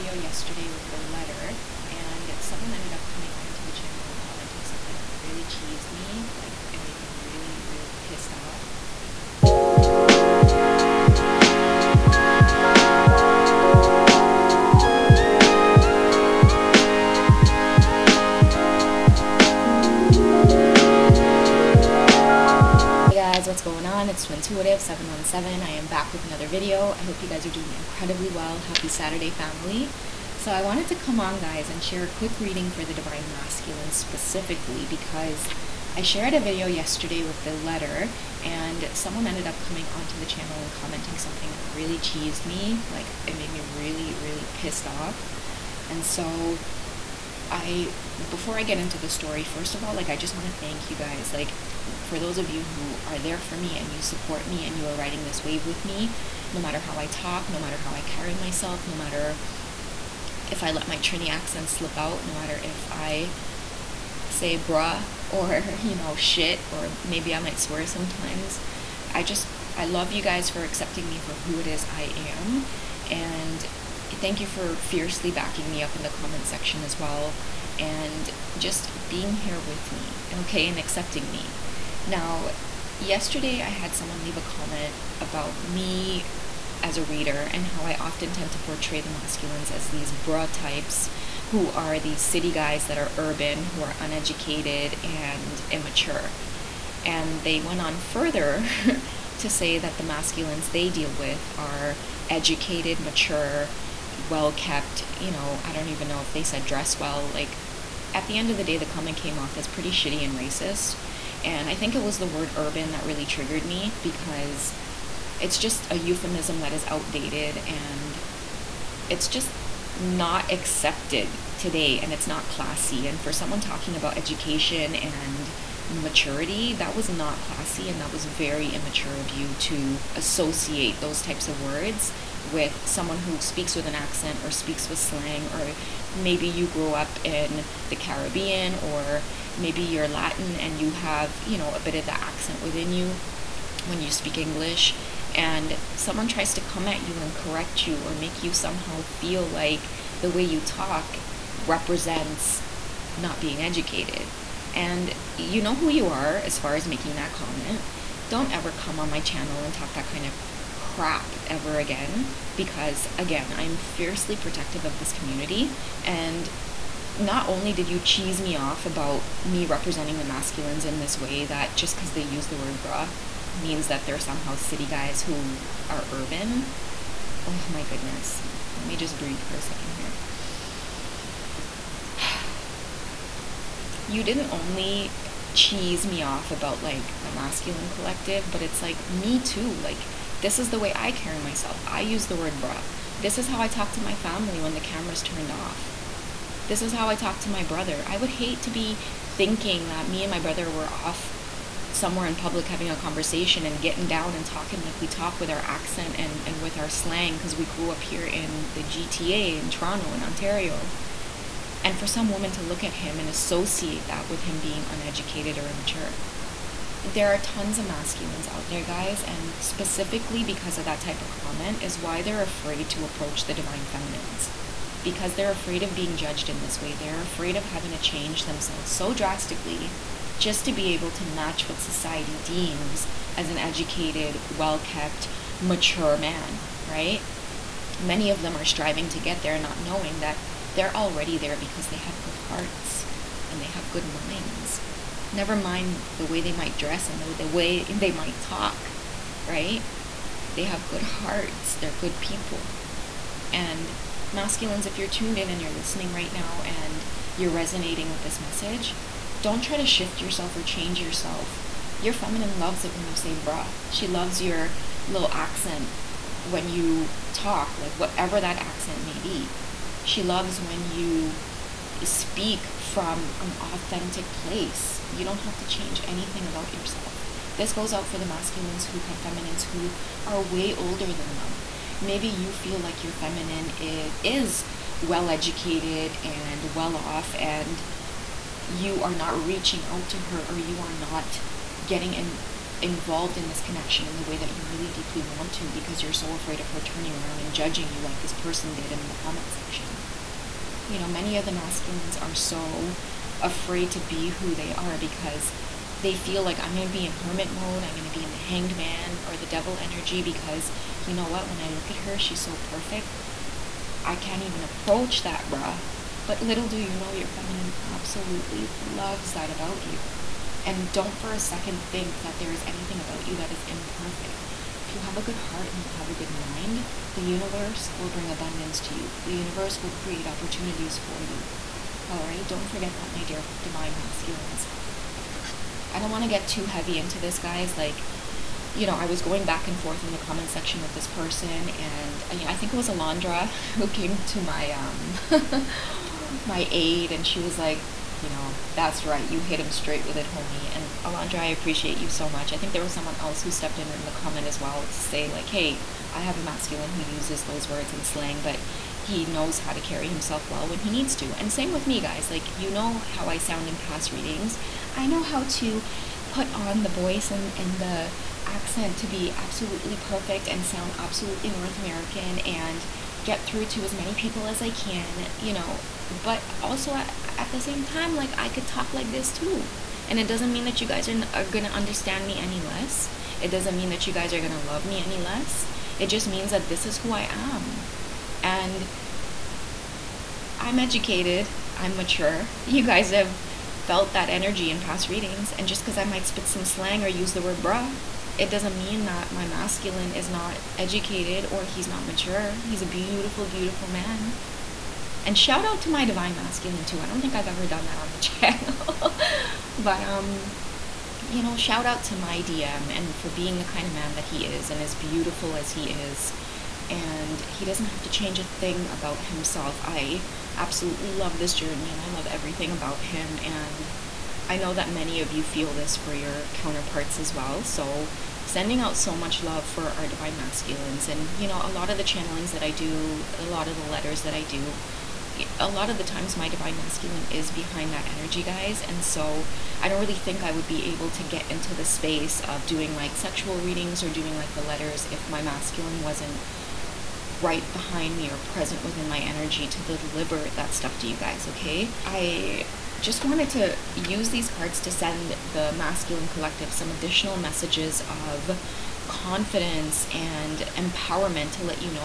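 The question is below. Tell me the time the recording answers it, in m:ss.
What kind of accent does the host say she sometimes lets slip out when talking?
1:00.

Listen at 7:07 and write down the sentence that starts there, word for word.
So, sending out so much love for our divine masculines.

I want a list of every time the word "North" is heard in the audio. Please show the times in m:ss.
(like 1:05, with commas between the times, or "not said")
6:11.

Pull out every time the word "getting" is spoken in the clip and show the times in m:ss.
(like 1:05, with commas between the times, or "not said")
3:23, 4:51.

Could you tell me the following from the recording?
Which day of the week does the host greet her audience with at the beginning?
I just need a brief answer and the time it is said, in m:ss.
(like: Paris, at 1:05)
Saturday, at 0:28.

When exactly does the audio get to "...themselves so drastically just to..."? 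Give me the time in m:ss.
3:48.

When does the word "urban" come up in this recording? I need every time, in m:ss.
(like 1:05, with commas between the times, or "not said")
1:33, 1:52, 2:56.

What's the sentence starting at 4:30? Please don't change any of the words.
She loves when you speak from an authentic place.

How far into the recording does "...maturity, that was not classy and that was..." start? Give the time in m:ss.
2:05.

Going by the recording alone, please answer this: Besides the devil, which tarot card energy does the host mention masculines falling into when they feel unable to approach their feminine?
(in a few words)
the hanged man.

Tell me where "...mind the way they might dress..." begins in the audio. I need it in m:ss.
4:05.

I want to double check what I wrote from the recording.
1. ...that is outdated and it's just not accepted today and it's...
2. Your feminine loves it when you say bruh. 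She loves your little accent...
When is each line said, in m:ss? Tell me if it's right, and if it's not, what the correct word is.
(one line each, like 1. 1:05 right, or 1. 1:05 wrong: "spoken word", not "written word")
1. 1:56 right
2. 4:21 right.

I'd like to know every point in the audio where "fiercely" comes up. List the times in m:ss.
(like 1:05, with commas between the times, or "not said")
1:14, 2:43.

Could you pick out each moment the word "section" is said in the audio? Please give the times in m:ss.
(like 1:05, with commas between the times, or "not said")
1:16, 4:59, 5:40.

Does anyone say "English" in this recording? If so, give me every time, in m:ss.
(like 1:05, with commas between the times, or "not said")
2:24.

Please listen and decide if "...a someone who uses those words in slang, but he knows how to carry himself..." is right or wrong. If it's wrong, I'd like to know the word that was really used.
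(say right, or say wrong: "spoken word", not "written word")
wrong: "masculine", not "someone".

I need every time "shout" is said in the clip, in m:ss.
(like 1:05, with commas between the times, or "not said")
6:45, 6:51.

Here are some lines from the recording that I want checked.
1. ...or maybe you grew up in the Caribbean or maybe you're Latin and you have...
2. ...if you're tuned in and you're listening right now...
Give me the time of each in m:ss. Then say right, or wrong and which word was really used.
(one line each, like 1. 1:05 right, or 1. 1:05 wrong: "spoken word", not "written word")
1. 2:15 right
2. 4:14 right.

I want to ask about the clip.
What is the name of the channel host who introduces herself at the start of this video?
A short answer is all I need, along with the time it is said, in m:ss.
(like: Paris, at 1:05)
Twintuitive717, at 0:24.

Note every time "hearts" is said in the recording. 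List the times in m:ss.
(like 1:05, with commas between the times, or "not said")
4:02, 4:11, 5:25.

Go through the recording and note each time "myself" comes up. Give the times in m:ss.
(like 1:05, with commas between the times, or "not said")
0:58, 3:11.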